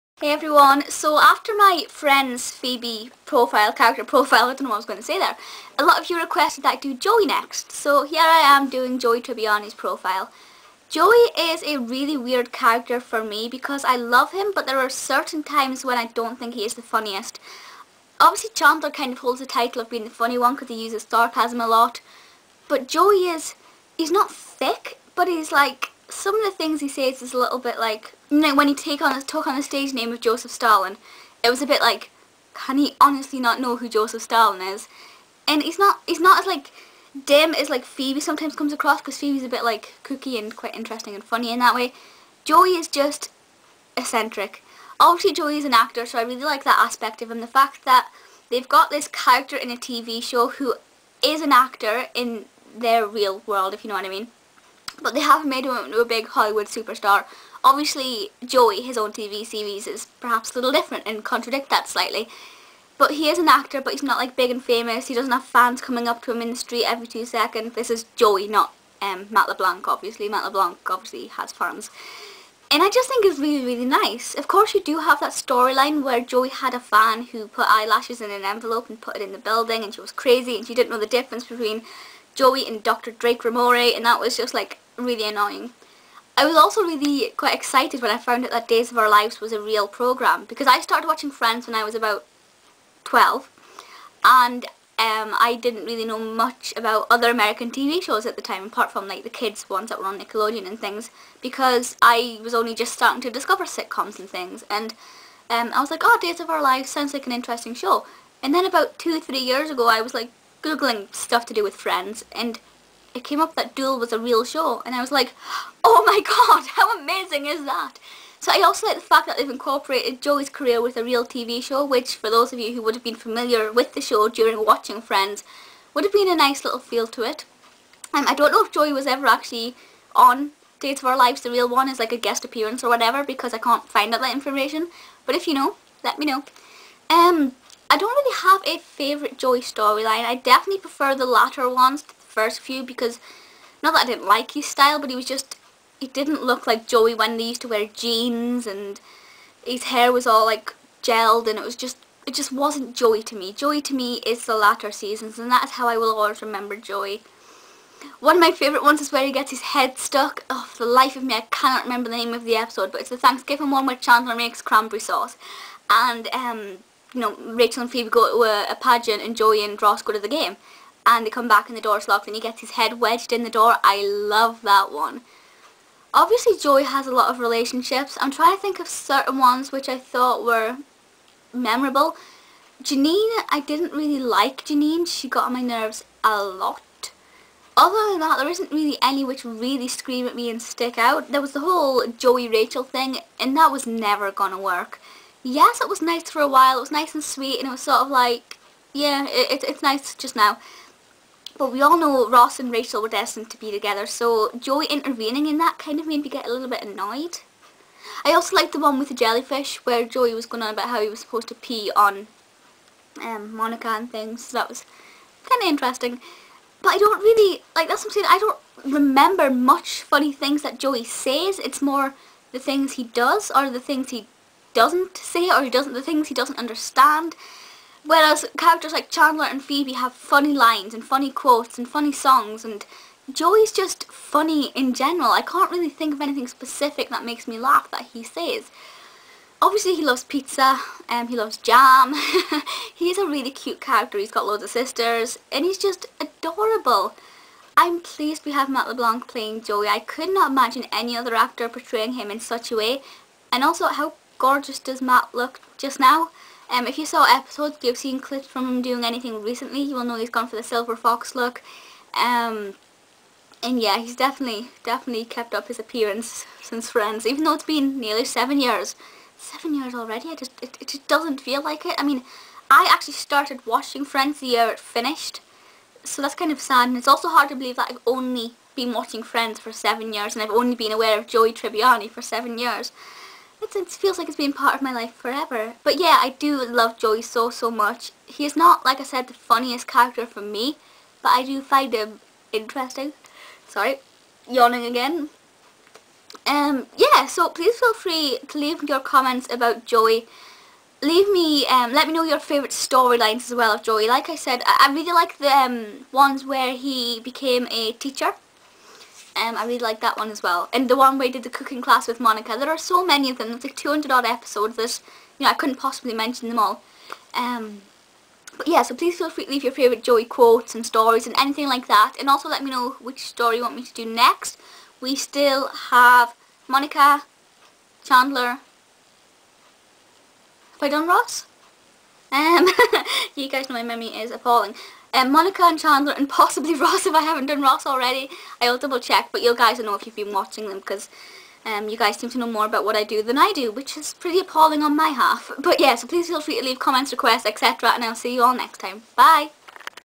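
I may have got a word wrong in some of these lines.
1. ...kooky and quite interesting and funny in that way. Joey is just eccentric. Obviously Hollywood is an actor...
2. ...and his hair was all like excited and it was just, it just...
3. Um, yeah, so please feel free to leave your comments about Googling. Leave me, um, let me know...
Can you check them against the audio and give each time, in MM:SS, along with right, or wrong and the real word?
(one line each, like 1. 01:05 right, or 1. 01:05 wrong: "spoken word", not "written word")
1. 00:40 wrong: "Joey", not "Hollywood"
2. 02:28 wrong: "gelled", not "excited"
3. 04:56 wrong: "Joey", not "Googling".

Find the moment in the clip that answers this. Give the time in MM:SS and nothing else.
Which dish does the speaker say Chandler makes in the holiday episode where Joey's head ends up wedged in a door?
02:44.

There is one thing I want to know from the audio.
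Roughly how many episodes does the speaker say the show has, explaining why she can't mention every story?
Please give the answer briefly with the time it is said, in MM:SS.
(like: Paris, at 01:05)
200, at 05:13.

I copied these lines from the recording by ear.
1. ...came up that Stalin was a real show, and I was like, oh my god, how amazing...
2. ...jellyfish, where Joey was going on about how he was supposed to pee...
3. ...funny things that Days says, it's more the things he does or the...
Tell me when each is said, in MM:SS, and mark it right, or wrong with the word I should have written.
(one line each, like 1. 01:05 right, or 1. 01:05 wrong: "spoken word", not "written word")
1. 01:53 wrong: "Duel", not "Stalin"
2. 03:29 right
3. 03:40 wrong: "Joey", not "Days".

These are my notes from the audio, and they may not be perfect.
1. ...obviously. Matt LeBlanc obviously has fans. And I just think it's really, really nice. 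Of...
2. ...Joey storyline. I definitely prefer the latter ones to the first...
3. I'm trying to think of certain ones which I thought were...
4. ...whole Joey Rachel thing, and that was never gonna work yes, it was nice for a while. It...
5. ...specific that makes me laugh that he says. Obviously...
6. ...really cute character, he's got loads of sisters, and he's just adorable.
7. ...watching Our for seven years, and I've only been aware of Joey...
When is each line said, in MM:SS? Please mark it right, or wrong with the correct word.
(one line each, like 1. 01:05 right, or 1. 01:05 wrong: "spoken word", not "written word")
1. 01:09 right
2. 02:19 right
3. 02:58 right
4. 03:11 right
5. 03:56 right
6. 04:03 right
7. 04:38 wrong: "Friends", not "Our".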